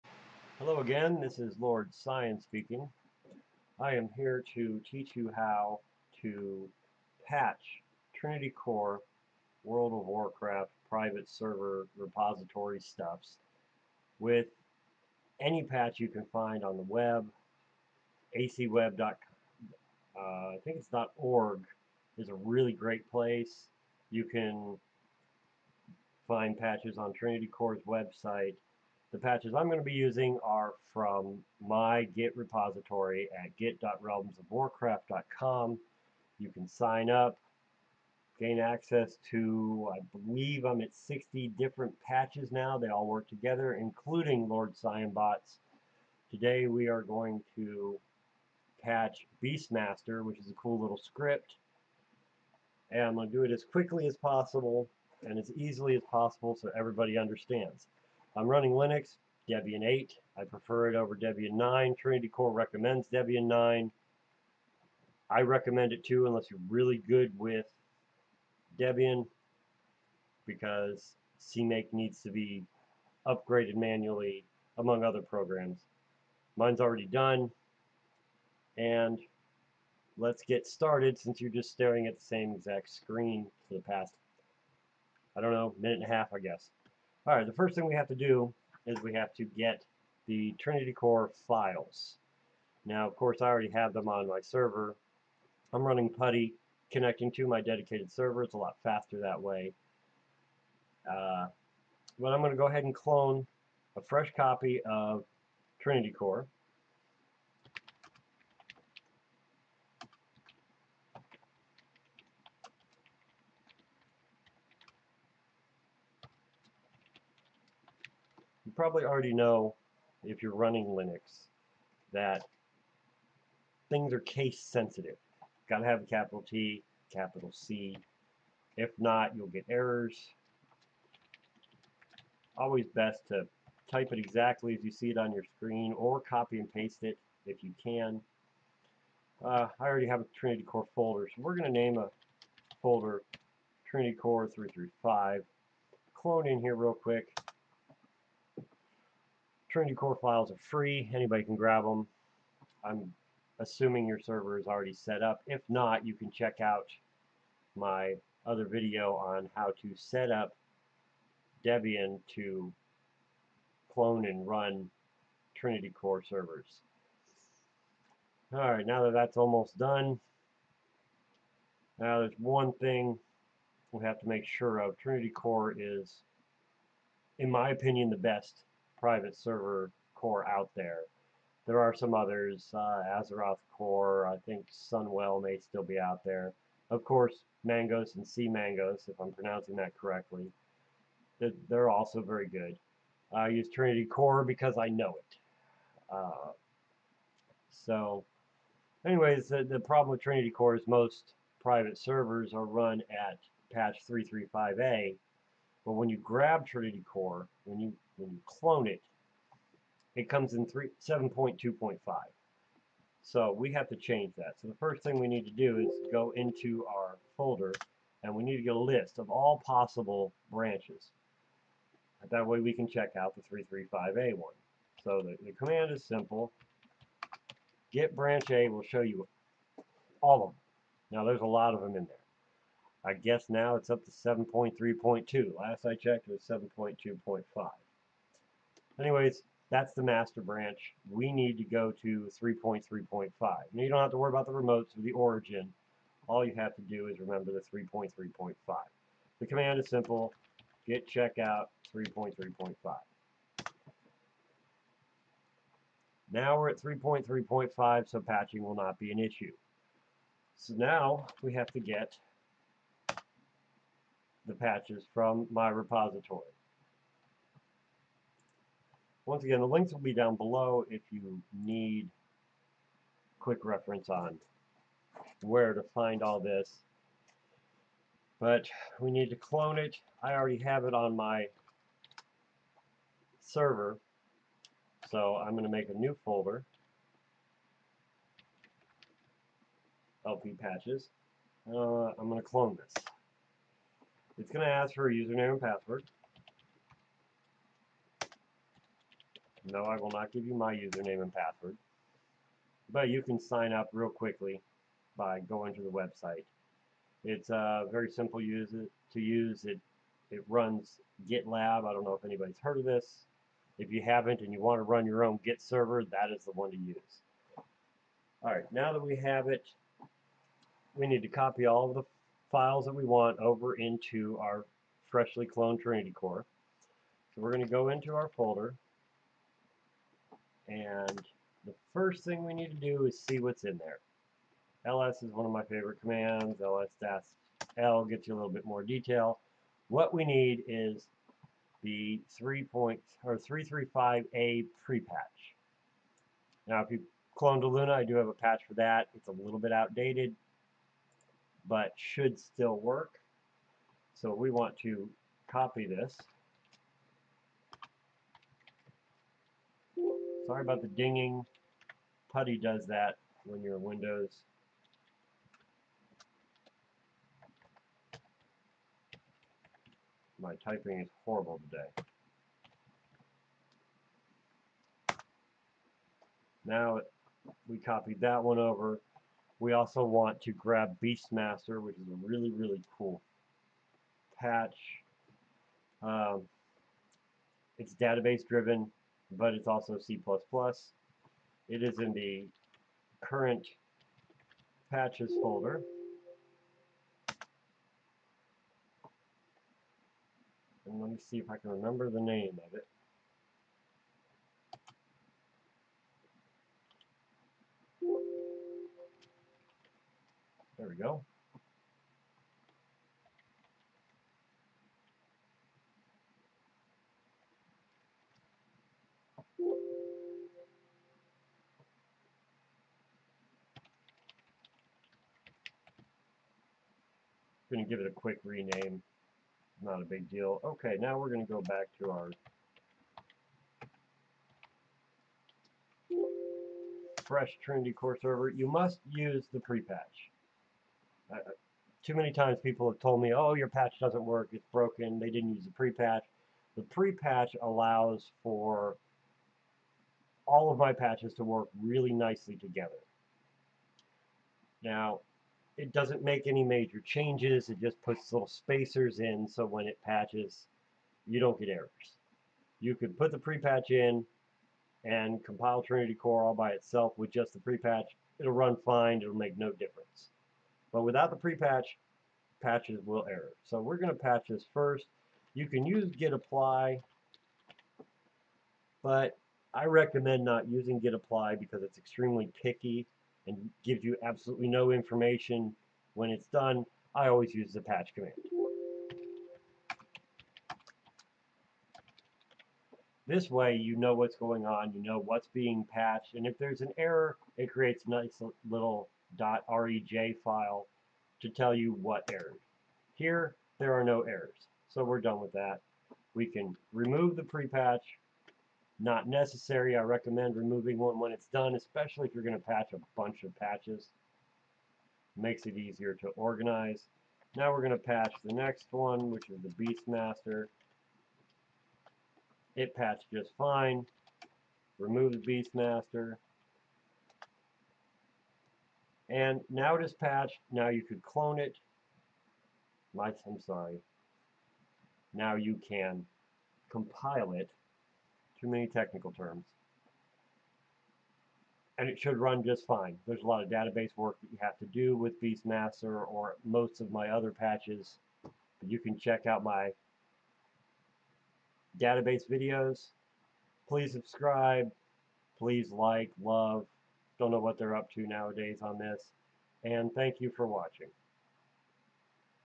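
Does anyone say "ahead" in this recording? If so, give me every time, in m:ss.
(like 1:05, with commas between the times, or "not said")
1:42.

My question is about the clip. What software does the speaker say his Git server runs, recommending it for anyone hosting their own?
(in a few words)
GitLab.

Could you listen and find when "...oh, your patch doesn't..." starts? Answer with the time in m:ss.
7:23.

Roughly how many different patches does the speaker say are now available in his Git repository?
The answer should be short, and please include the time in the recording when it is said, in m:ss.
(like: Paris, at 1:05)
60, at 0:40.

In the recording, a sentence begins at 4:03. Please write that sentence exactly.
Now you don't have to worry about the remotes or the origin.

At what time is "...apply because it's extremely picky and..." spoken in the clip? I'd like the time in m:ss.
8:01.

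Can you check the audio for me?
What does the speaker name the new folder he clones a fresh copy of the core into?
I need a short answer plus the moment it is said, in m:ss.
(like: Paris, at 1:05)
Trinity Core 335, at 2:23.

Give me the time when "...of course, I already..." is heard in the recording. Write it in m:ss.
1:33.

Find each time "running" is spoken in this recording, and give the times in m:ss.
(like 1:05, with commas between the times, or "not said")
0:58, 1:35, 2:00.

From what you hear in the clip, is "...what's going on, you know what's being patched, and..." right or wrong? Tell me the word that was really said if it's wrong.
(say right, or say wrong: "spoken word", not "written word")
right.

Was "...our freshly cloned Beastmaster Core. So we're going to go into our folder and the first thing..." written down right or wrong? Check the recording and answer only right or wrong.
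wrong.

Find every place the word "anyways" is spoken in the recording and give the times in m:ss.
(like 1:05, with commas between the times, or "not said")
3:19, 3:58.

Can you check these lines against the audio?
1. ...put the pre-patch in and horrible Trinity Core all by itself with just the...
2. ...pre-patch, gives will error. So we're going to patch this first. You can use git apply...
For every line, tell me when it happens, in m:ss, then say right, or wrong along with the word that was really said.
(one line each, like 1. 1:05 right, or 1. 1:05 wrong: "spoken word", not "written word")
1. 7:43 wrong: "compile", not "horrible"
2. 7:51 wrong: "patches", not "gives".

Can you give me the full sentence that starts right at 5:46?
Now if you clone to Eluna, I do have a patch for that.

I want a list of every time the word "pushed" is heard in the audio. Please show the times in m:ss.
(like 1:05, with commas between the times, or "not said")
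not said.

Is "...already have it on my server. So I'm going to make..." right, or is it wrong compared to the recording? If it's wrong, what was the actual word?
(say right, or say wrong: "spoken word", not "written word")
right.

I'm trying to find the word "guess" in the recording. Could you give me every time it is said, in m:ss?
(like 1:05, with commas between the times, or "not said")
1:26, 3:53.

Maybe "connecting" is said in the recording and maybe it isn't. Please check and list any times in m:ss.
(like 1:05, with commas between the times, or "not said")
1:36.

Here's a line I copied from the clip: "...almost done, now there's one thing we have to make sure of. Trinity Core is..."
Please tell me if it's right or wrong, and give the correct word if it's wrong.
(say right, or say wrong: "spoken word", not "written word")
right.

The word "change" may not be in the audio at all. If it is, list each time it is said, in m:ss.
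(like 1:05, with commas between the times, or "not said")
3:33, 7:37.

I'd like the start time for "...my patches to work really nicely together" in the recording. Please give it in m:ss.
7:30.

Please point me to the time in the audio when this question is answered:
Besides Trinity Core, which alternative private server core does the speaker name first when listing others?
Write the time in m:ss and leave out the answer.
3:03.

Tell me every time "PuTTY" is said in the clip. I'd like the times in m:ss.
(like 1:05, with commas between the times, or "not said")
1:36, 6:02.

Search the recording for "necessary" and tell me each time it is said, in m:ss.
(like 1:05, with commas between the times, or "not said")
8:29.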